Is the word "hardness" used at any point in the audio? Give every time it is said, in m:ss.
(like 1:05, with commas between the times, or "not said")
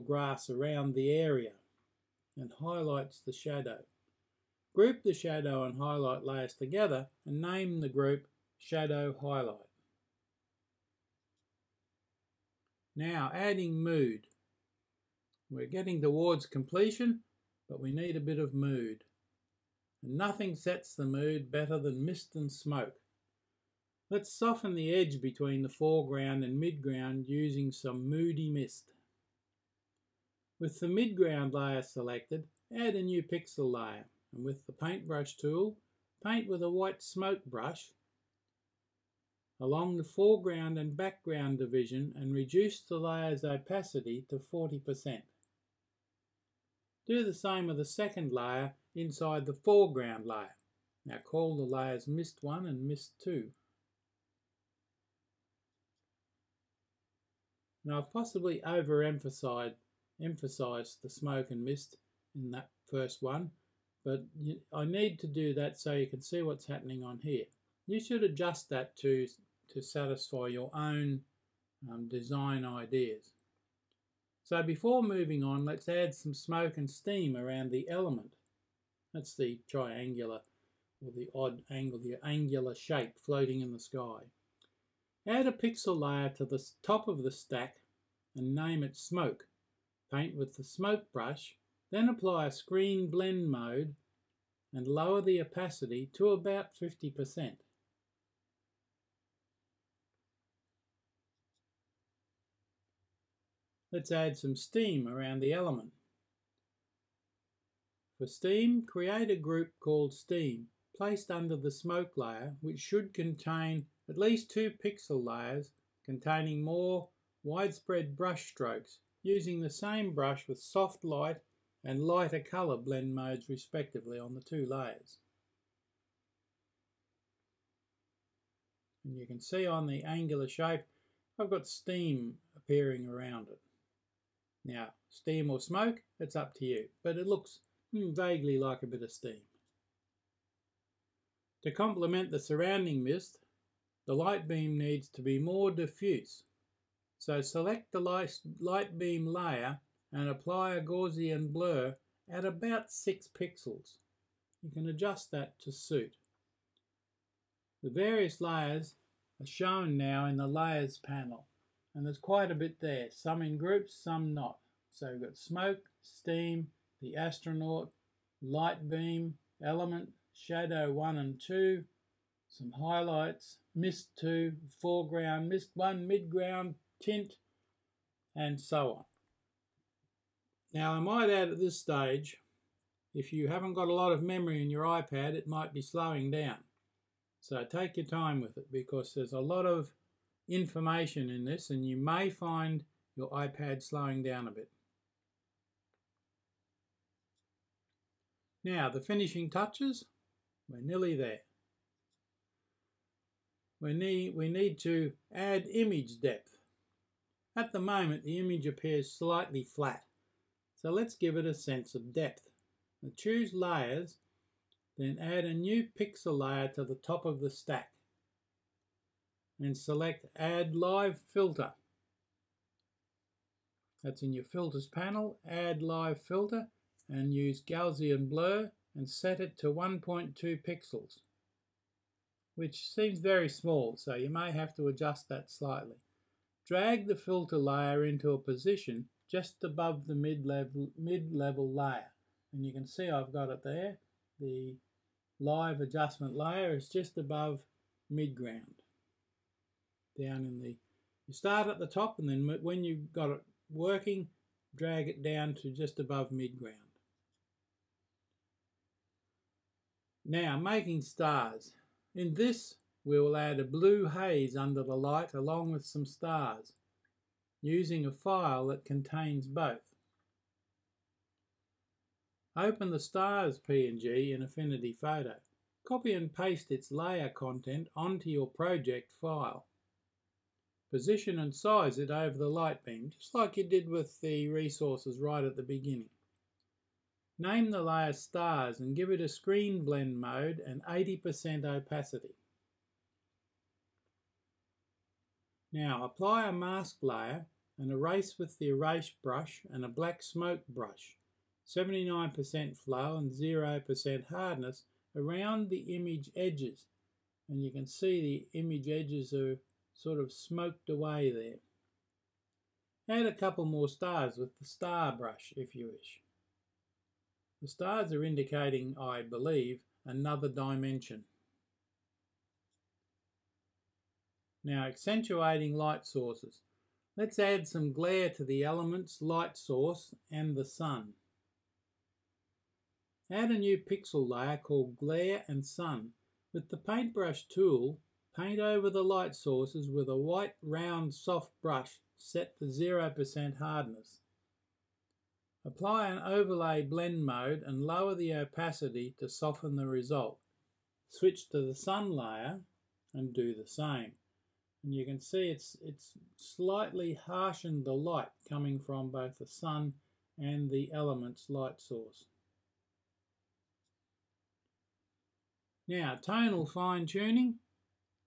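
5:04, 5:43.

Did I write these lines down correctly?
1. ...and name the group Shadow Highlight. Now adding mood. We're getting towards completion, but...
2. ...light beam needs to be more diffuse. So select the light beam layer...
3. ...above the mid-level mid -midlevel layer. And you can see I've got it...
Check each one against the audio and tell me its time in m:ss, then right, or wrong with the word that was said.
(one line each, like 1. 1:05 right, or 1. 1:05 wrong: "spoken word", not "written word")
1. 0:07 right
2. 2:24 right
3. 3:59 wrong: "level", not "midlevel".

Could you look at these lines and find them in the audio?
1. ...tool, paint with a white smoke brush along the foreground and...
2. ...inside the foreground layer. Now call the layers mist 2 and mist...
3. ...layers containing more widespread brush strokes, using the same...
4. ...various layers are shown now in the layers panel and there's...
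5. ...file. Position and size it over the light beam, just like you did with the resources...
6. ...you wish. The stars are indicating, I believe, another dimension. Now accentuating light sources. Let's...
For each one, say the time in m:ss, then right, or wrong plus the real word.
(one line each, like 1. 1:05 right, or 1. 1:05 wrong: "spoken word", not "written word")
1. 0:35 right
2. 0:48 wrong: "1", not "2"
3. 1:55 right
4. 2:37 right
5. 4:39 right
6. 5:15 right.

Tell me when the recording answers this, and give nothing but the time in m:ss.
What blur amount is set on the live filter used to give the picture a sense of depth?
3:49.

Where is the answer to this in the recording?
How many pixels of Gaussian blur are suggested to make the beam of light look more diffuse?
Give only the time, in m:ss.
2:32.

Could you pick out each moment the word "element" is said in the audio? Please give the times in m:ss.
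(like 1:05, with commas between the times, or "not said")
1:17, 1:45, 2:49, 5:28, 6:00.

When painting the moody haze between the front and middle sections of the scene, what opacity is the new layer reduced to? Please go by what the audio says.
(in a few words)
40%.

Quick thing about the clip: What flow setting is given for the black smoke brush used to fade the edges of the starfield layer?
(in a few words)
79%.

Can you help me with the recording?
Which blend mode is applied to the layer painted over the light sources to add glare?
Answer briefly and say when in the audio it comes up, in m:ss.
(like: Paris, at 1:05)
Overlay, at 5:46.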